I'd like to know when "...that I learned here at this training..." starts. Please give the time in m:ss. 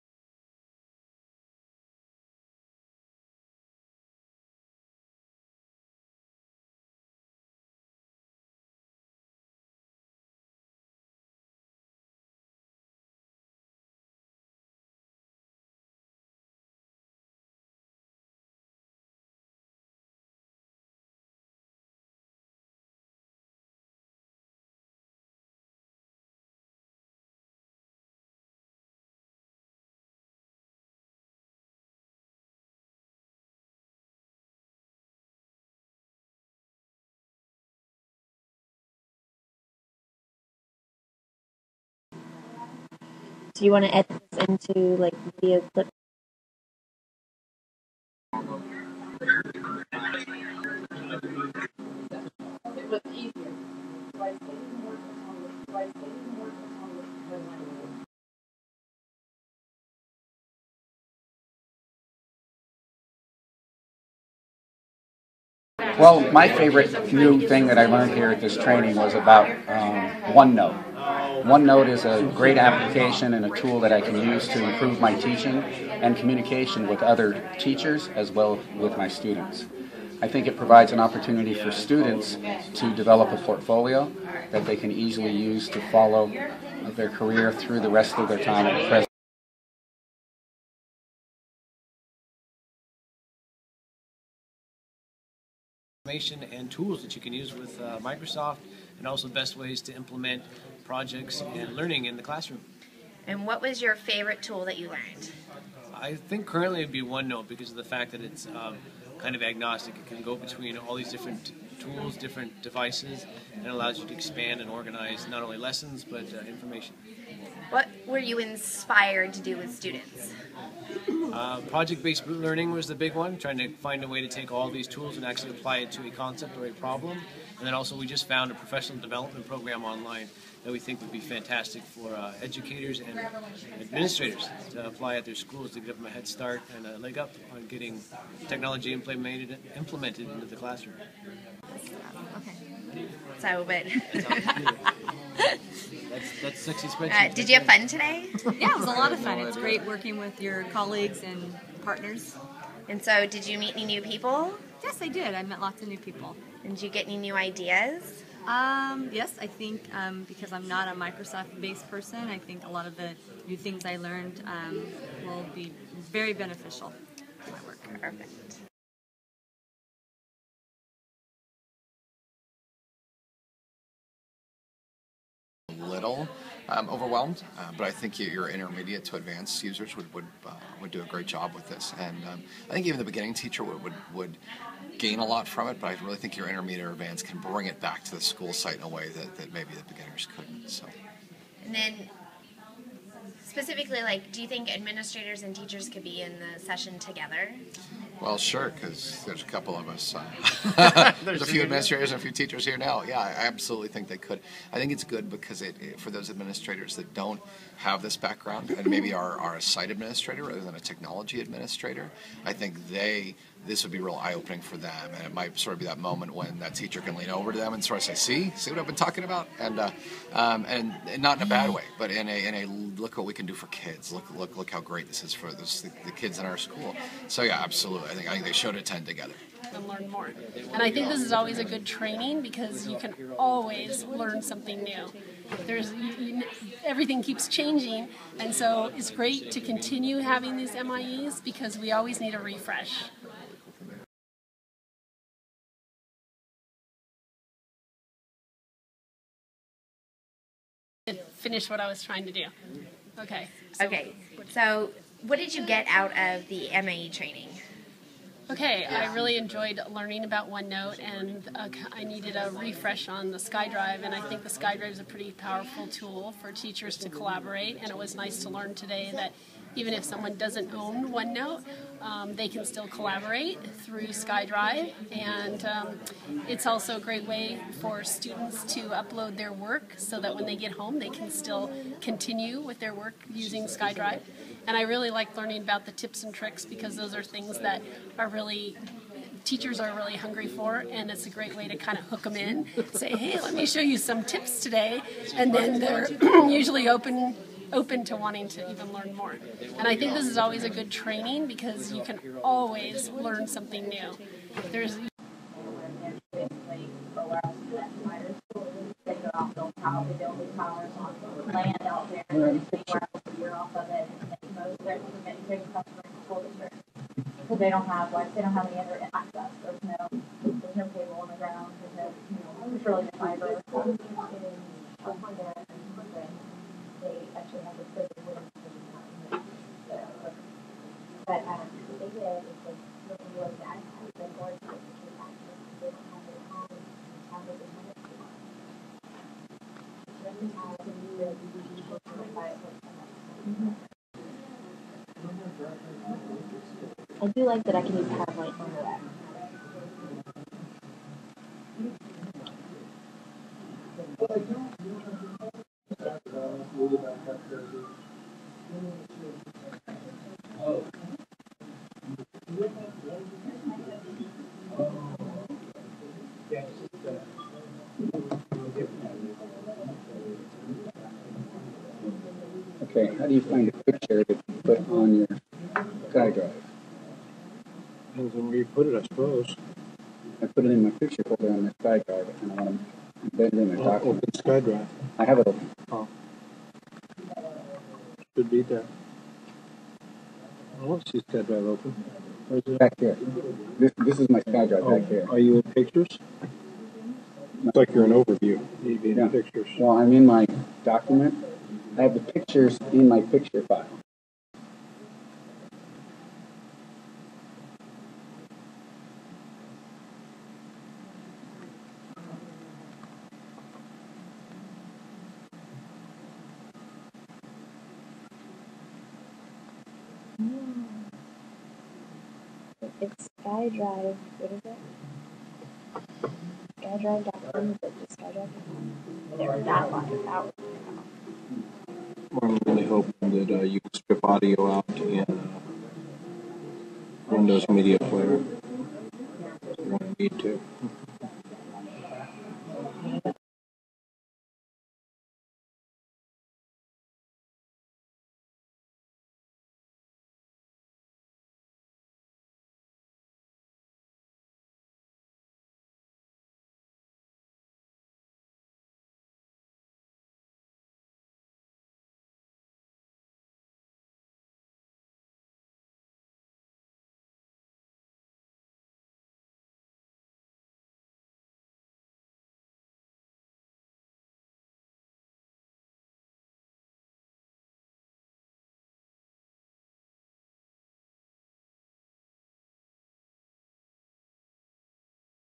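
1:07.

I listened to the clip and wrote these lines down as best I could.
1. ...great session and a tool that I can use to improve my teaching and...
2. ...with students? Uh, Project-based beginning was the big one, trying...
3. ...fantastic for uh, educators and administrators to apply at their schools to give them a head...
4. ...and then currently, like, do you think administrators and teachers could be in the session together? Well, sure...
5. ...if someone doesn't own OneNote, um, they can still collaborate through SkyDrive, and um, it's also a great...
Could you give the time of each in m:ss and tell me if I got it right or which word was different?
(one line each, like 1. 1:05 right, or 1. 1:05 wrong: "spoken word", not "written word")
1. 1:12 wrong: "application", not "session"
2. 1:59 wrong: "learning", not "beginning"
3. 2:11 right
4. 3:11 wrong: "specifically", not "currently"
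5. 4:29 right.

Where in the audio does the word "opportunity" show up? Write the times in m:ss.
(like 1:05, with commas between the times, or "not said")
1:20.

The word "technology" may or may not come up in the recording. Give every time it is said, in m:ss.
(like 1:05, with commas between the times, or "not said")
2:18, 3:30.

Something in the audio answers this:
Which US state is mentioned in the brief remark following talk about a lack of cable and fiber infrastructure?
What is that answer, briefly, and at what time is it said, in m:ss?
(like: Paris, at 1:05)
California, at 5:23.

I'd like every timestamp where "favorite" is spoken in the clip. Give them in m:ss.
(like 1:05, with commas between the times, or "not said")
1:06, 1:43.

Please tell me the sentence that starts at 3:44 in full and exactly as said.
Look look look how great this is for this, the, the kids in our school.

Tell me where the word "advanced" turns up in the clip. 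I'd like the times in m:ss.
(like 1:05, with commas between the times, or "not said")
2:59, 3:06.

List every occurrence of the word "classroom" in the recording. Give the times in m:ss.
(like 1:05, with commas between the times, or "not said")
1:42, 2:20.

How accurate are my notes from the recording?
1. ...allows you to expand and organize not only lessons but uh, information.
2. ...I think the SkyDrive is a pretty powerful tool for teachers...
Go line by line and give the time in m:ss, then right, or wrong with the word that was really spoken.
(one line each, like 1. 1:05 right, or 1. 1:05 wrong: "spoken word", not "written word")
1. 1:53 right
2. 4:24 right.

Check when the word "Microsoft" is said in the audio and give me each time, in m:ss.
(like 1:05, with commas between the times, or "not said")
1:37, 2:40.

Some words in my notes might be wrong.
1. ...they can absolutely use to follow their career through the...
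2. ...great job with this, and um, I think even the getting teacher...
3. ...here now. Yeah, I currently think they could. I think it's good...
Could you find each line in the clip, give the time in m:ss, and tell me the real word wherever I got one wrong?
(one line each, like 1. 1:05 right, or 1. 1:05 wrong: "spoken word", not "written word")
1. 1:24 wrong: "easily", not "absolutely"
2. 3:01 wrong: "beginning", not "getting"
3. 3:22 wrong: "absolutely", not "currently".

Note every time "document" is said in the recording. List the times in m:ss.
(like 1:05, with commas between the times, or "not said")
6:23, 6:40.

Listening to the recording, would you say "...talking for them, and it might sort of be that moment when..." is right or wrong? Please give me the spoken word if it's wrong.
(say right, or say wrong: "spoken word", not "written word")
wrong: "opening", not "talking".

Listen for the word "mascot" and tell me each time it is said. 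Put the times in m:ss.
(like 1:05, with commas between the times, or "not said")
not said.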